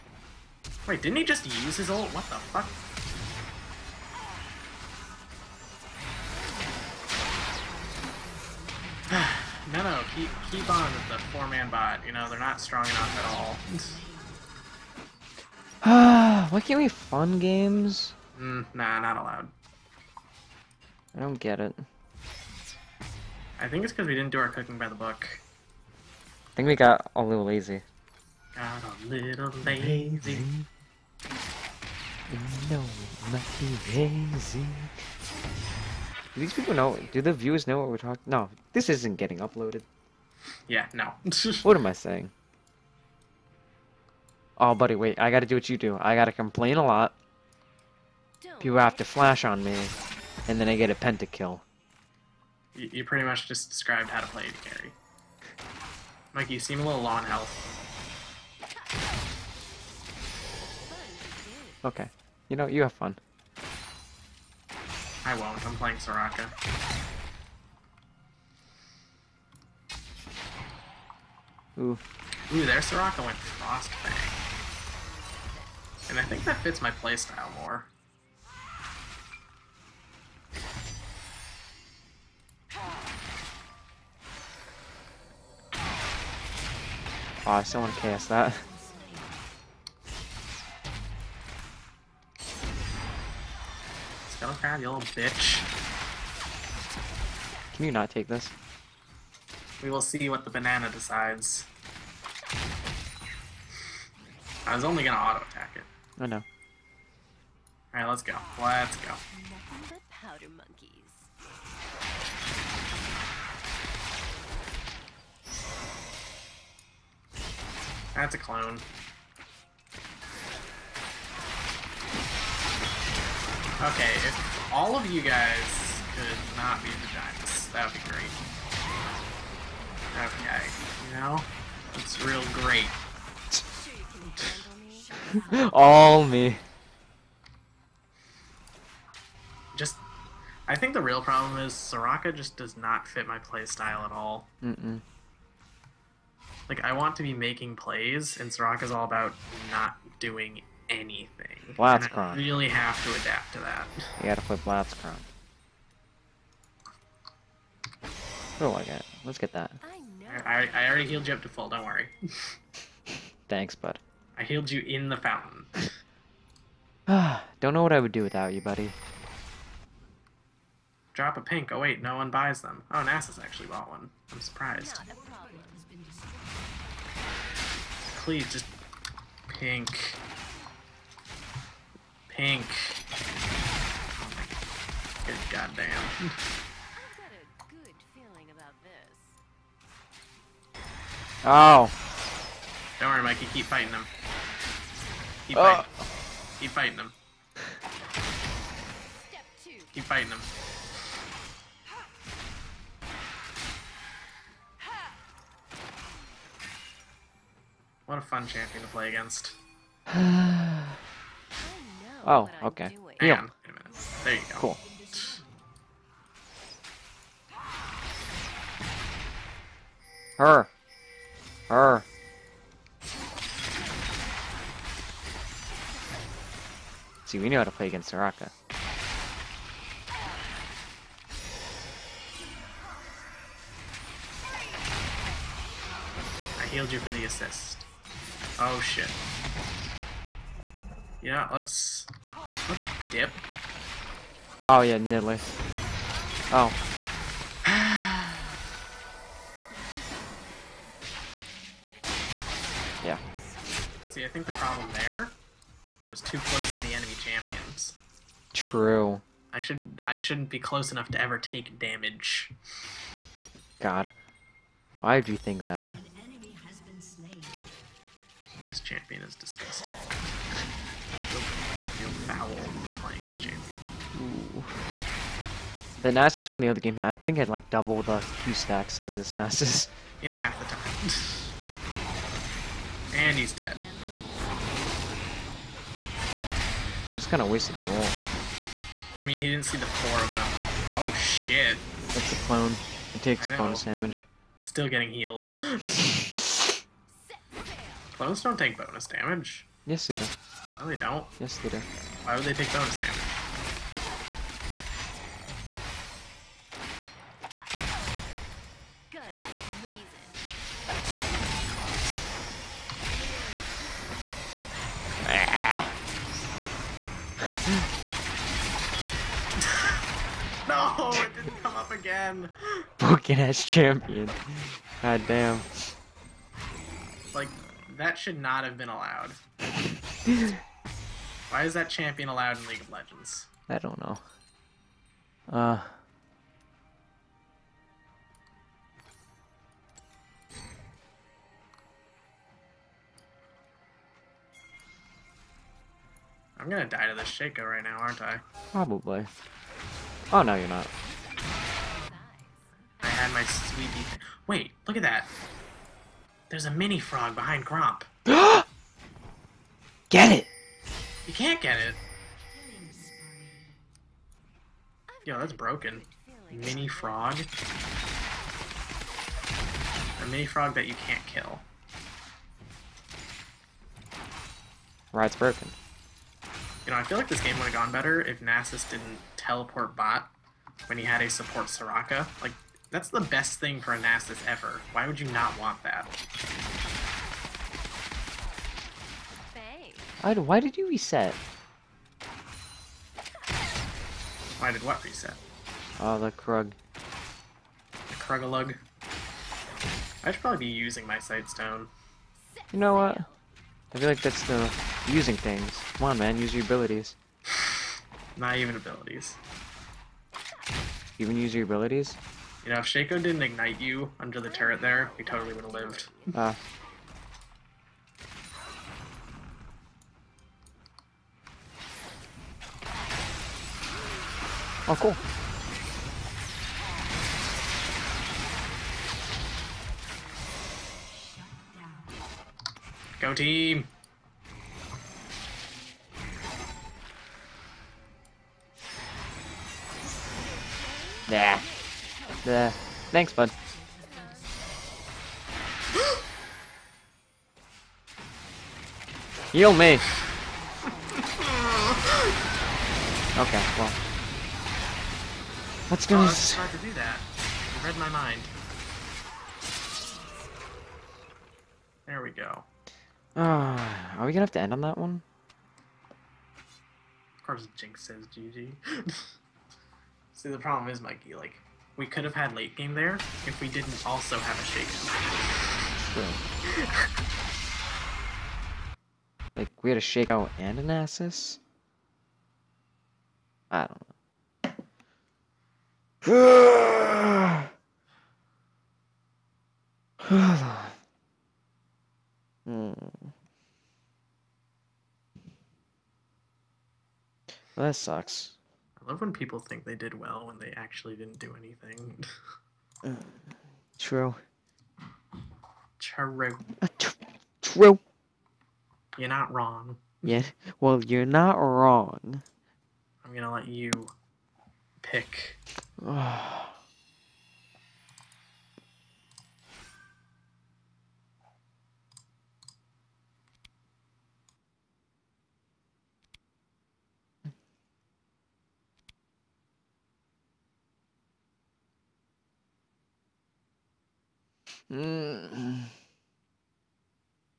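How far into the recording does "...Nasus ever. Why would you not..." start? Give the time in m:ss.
6:23.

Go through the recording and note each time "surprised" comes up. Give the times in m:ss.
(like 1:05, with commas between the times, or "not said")
2:54.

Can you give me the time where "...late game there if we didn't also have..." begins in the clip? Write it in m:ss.
7:52.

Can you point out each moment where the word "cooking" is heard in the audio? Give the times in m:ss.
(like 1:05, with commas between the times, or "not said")
0:24.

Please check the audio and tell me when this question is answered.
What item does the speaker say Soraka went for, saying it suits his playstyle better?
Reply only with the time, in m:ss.
1:13.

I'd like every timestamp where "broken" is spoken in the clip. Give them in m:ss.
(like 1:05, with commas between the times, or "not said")
5:22, 6:05, 6:15.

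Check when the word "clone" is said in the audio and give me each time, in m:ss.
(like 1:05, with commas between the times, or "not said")
1:58, 4:52, 4:58.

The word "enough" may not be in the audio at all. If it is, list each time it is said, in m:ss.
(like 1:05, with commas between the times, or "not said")
0:12, 4:20.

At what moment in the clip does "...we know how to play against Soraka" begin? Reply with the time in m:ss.
3:47.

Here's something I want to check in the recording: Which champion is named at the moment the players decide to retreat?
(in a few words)
Nidalee.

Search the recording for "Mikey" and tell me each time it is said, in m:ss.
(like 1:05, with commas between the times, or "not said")
0:56, 3:13, 7:51.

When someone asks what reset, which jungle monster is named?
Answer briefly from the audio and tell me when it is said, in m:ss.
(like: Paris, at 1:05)
Krug, at 6:36.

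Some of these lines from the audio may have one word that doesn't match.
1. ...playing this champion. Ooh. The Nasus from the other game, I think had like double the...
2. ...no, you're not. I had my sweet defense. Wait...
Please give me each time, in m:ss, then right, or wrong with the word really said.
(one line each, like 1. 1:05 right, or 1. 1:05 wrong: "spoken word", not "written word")
1. 4:33 right
2. 5:50 right.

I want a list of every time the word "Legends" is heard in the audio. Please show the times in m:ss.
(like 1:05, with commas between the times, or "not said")
5:32.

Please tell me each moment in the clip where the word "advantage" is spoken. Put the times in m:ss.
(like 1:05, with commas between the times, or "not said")
not said.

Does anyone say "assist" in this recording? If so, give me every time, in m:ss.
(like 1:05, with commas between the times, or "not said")
3:57, 8:00.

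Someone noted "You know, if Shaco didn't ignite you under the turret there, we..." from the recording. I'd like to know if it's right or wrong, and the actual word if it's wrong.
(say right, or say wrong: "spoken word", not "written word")
right.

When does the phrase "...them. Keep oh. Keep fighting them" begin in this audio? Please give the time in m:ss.
3:13.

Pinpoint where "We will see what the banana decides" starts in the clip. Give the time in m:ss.
1:39.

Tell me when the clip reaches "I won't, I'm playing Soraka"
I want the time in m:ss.
1:05.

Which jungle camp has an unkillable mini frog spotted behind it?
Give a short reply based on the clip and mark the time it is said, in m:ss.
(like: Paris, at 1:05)
Gromp, at 5:57.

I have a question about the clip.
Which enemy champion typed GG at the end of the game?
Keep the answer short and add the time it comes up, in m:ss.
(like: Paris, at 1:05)
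Jinx, at 7:47.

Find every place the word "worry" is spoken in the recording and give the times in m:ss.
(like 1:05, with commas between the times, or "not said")
2:41, 3:13.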